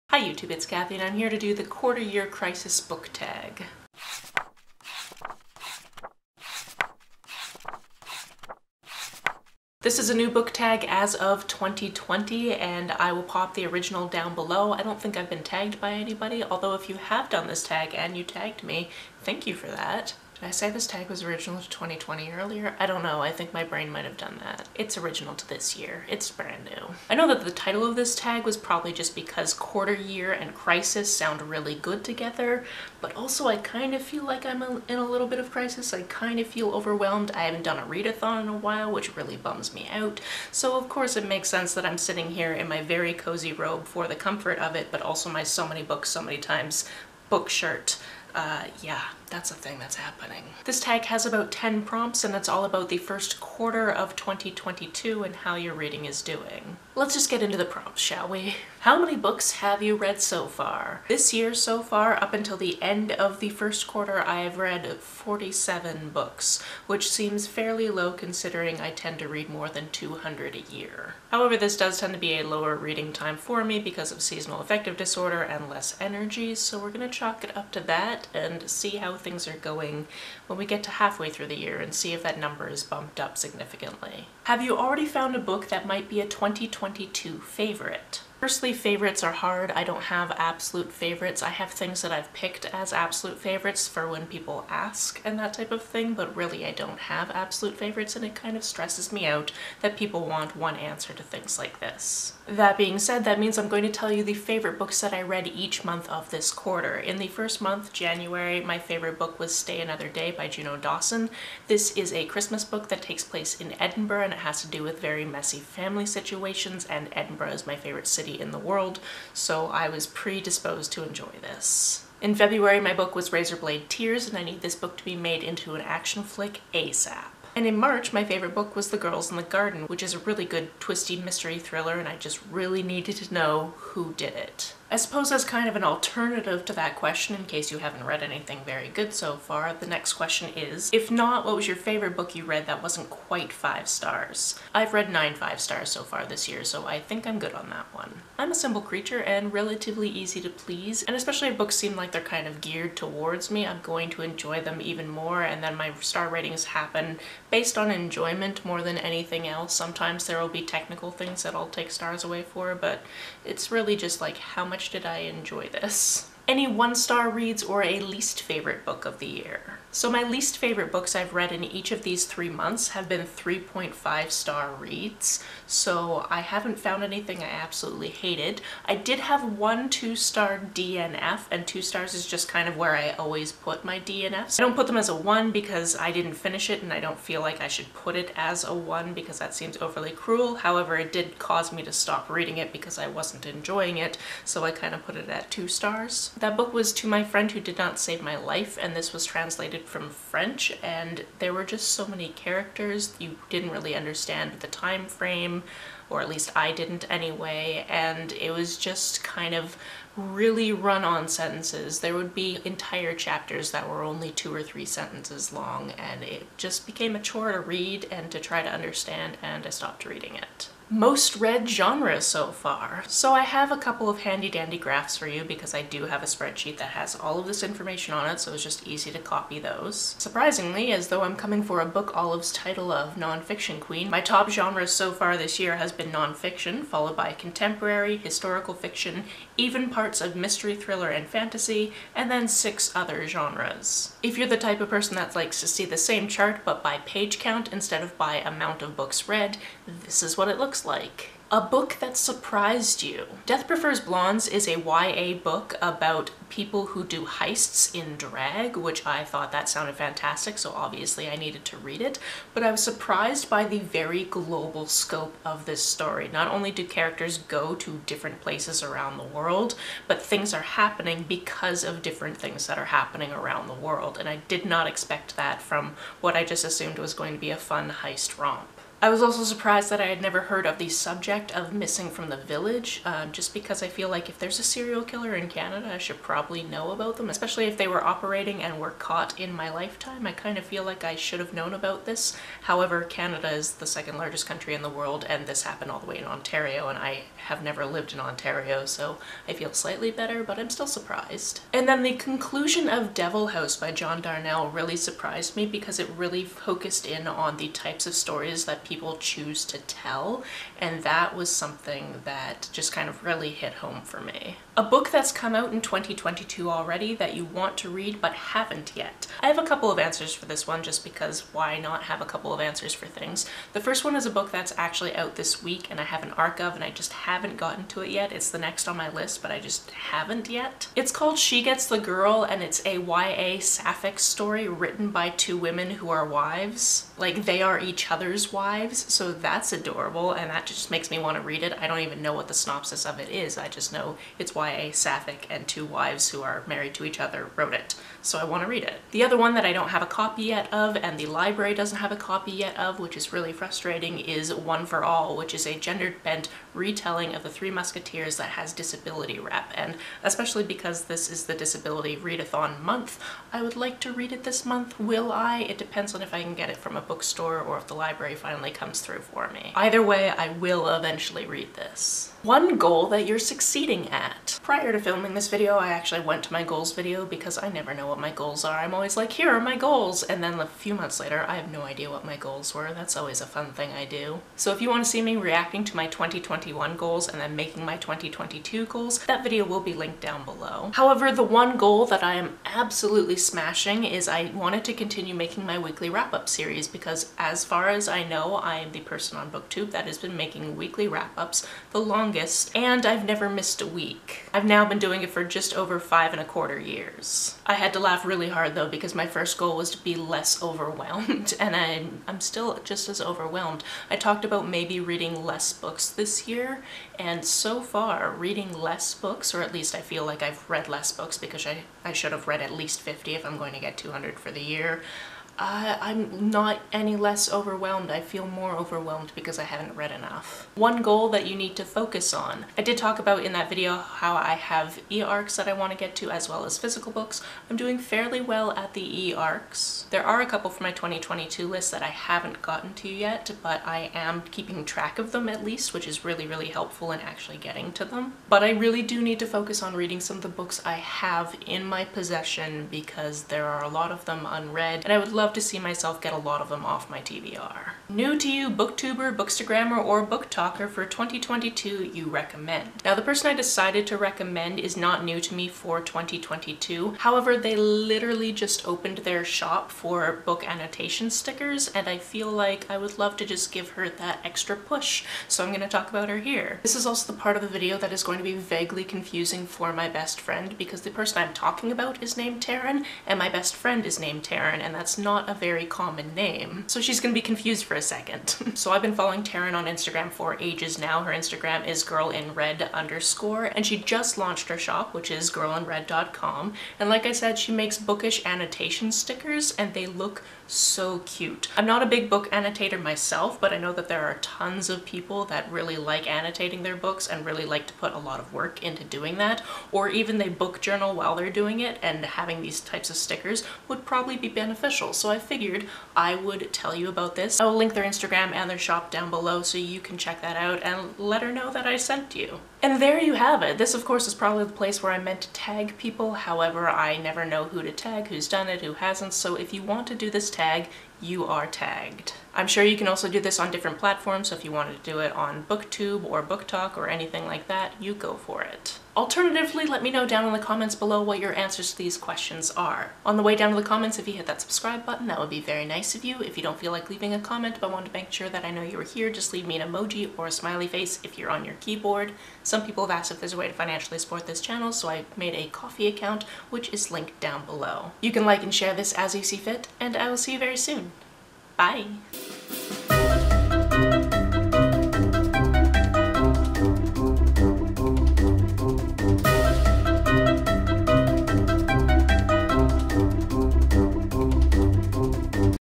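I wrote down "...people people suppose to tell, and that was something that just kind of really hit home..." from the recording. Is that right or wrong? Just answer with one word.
wrong.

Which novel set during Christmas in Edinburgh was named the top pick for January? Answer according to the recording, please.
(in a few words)
Stay Another Day.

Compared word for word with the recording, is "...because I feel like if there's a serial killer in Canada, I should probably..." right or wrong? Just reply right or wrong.
right.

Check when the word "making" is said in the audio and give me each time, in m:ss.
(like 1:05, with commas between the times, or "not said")
6:27, 6:35, 6:40.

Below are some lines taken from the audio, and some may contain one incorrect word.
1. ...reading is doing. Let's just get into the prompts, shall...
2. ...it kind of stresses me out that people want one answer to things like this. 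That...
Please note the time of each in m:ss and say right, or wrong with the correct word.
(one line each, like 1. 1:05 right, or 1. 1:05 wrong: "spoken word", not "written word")
1. 0:55 right
2. 1:38 right.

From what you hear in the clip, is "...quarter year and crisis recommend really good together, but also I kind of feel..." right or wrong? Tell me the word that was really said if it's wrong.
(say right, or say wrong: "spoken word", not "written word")
wrong: "sound", not "recommend".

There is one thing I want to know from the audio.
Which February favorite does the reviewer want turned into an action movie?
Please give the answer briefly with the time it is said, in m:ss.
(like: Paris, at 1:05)
Razorblade Tears, at 2:03.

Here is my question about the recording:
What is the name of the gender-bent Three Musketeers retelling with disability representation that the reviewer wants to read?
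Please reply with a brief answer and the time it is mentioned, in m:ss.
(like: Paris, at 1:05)
One for All, at 5:54.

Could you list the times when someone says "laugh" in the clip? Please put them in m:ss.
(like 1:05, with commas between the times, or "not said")
6:47.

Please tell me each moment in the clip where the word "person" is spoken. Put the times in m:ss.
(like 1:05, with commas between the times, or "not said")
4:04, 6:39, 7:43, 8:01.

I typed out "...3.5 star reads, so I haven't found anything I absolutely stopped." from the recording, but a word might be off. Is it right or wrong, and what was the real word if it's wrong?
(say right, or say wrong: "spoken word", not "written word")
wrong: "hated", not "stopped".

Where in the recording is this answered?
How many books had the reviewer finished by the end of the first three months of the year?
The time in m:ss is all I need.
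1:04.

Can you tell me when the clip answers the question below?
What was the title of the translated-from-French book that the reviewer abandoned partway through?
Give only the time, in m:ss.
3:16.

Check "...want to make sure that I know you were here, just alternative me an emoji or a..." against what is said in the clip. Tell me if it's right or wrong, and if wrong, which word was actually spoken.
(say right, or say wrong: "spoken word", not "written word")
wrong: "leave", not "alternative".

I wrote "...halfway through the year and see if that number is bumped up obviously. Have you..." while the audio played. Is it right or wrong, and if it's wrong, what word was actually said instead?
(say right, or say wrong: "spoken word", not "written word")
wrong: "significantly", not "obviously".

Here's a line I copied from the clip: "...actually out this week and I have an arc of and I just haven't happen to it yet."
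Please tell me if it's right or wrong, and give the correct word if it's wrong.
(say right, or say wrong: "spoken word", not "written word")
wrong: "gotten", not "happen".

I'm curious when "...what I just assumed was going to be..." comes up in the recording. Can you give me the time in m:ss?
4:36.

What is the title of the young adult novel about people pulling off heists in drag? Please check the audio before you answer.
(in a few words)
Death Prefers Blondes.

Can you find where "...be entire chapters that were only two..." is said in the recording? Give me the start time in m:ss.
3:32.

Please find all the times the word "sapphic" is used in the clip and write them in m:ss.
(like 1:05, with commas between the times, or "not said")
5:33, 5:44.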